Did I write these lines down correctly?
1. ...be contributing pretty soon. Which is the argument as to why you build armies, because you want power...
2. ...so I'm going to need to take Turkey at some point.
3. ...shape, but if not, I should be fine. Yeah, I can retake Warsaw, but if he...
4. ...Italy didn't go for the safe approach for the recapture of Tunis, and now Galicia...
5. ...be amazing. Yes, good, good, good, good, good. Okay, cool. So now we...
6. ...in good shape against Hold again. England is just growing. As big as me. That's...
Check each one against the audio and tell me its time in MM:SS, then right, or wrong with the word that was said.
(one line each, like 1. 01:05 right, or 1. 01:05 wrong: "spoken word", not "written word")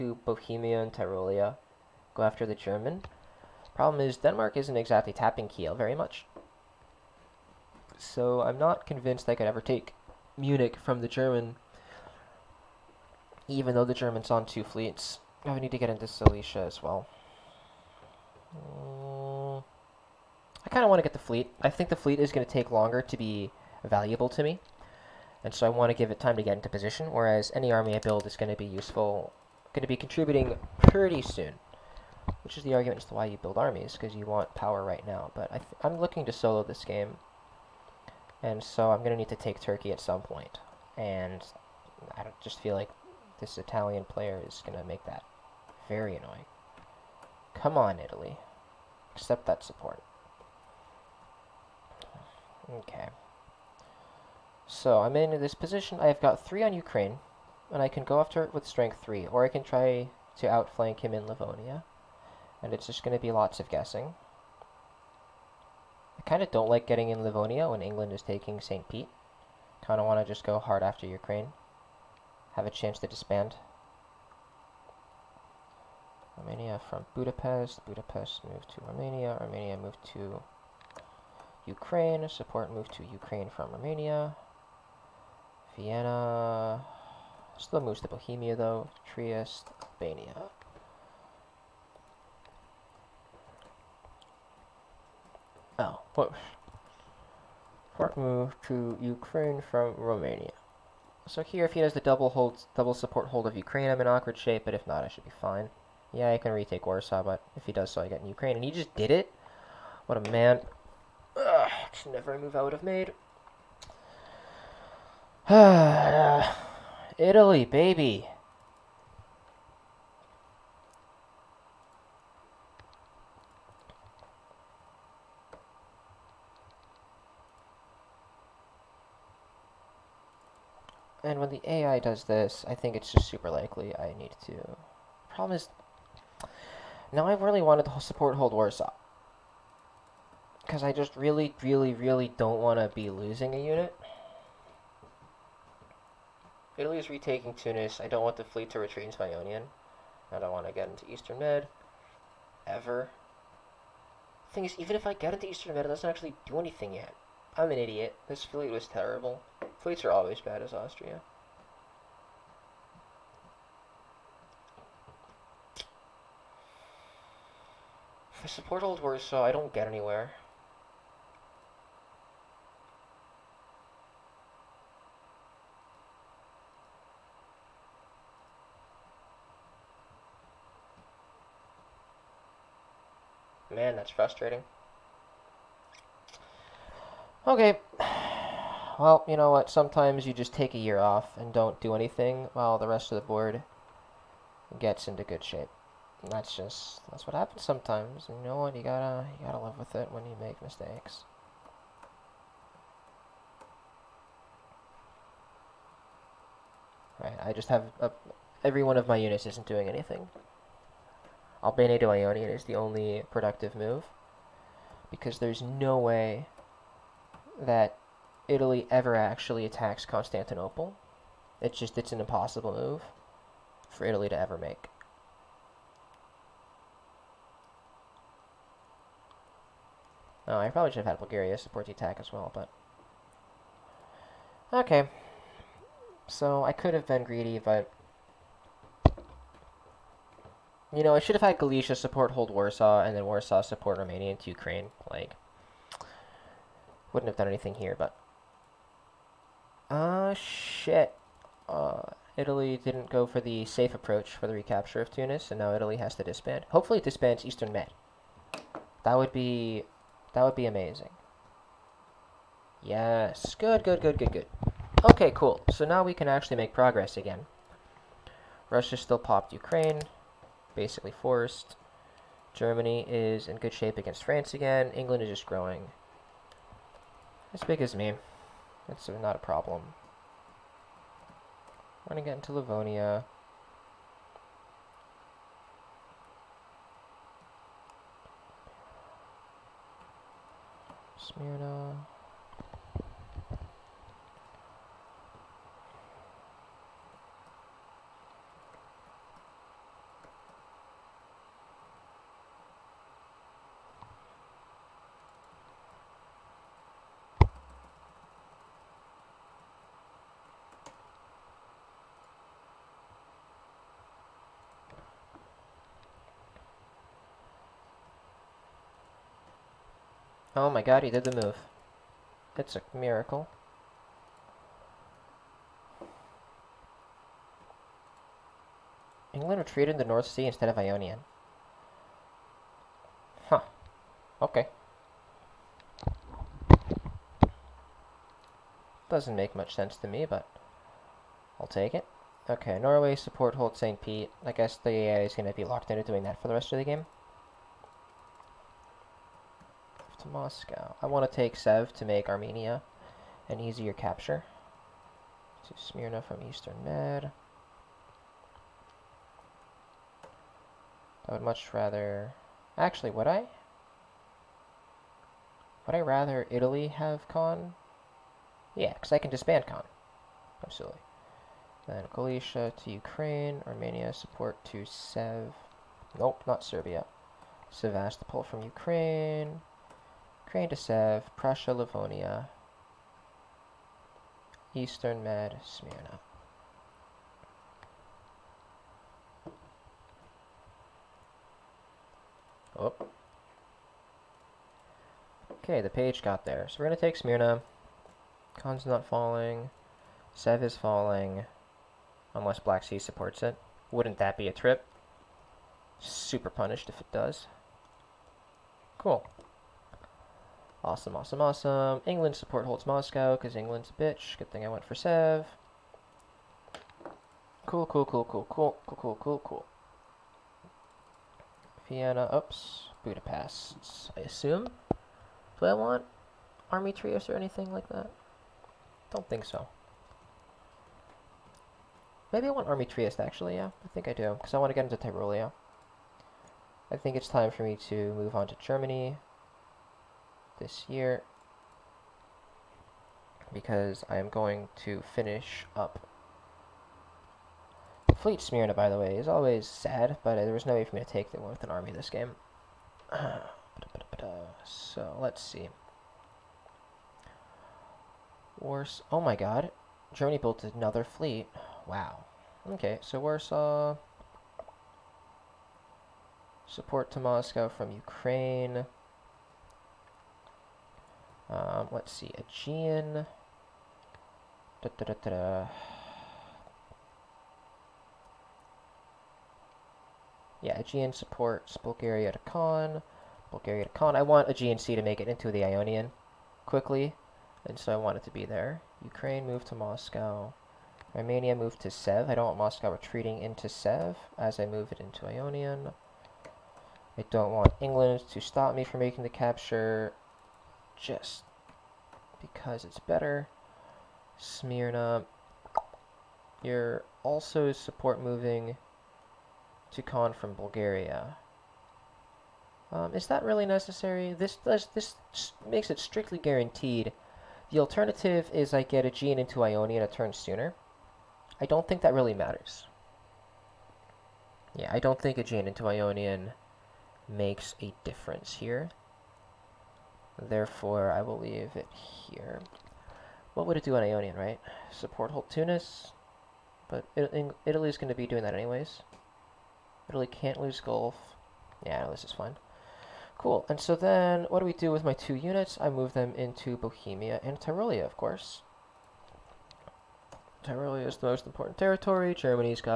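1. 00:29 right
2. 00:38 right
3. 01:44 right
4. 04:12 wrong: "Italy", not "Galicia"
5. 04:20 right
6. 04:33 wrong: "France", not "Hold".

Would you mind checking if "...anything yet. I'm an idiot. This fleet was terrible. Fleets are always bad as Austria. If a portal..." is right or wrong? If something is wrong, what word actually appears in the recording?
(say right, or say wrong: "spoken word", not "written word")
right.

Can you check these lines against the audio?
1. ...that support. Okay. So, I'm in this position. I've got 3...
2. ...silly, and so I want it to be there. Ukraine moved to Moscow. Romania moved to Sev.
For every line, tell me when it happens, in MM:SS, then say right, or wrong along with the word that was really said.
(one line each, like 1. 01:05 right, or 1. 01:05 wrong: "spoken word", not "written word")
1. 00:49 right
2. 08:06 wrong: "quickly", not "silly".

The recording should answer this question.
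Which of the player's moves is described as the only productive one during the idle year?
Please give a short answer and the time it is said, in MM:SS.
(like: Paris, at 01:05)
Albania to Ionian, at 03:31.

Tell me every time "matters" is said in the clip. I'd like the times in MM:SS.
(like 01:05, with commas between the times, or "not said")
08:42.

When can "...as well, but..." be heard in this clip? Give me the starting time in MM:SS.
03:52.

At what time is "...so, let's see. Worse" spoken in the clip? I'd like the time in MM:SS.
07:34.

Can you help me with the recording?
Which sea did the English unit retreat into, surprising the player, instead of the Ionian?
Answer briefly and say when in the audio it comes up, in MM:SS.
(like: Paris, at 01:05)
North Sea, at 05:30.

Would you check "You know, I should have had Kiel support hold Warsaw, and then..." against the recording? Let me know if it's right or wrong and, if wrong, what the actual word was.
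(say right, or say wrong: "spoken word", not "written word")
wrong: "Galicia", not "Kiel".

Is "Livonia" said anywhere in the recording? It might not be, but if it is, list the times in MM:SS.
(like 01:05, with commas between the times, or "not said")
01:01, 01:07, 04:42, 06:21.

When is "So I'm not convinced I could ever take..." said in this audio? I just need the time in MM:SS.
00:07.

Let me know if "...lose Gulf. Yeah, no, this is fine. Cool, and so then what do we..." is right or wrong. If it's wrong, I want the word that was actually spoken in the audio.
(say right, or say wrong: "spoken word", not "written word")
right.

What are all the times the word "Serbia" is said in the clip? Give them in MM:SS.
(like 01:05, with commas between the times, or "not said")
06:16.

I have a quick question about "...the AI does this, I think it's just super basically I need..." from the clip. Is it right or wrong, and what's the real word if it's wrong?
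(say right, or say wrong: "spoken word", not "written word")
wrong: "likely", not "basically".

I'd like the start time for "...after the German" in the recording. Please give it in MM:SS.
00:02.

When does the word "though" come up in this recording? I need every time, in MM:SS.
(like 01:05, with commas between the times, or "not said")
00:13, 01:28.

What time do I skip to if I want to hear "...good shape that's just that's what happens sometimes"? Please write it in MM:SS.
03:15.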